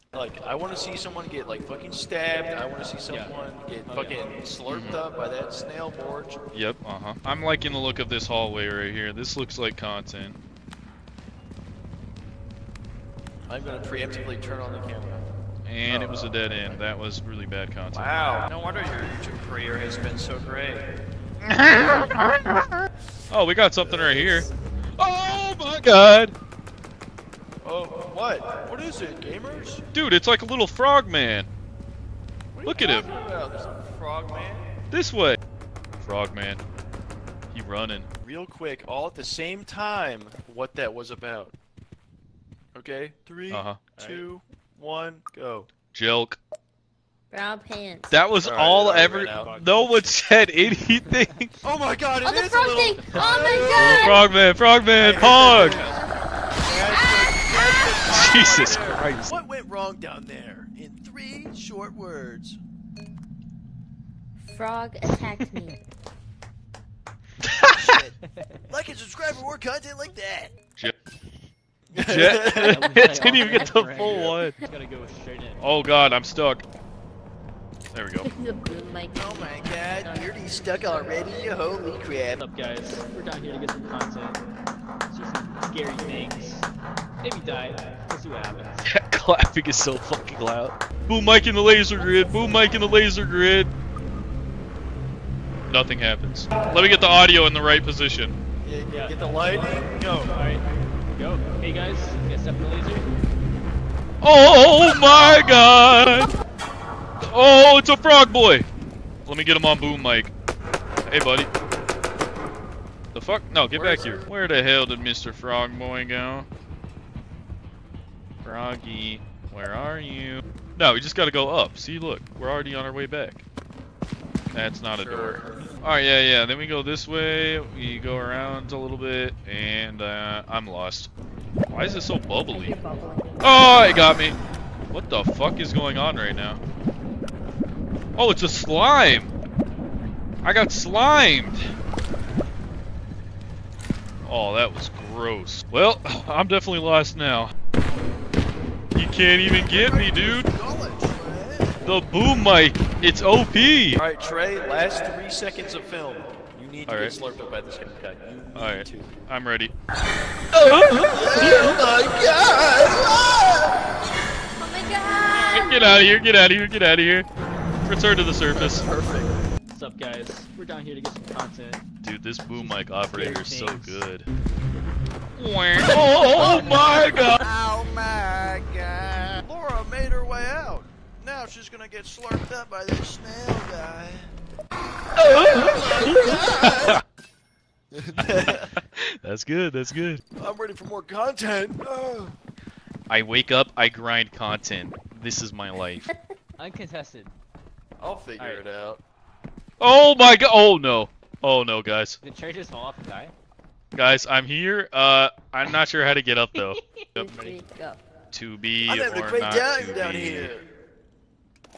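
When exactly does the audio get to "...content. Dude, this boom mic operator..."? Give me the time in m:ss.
2:51.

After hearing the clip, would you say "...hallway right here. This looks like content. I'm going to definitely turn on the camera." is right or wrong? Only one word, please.
wrong.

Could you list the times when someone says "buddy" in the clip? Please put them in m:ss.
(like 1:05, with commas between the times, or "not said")
1:51.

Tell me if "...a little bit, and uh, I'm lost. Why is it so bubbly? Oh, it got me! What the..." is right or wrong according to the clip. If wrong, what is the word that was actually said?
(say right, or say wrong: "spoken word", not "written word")
right.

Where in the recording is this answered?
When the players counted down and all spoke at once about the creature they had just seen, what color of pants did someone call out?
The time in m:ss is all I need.
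0:47.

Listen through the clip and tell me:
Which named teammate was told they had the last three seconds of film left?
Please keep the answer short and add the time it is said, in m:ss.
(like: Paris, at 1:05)
Trey, at 2:34.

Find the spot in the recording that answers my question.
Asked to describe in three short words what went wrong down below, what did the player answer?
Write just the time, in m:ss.
1:04.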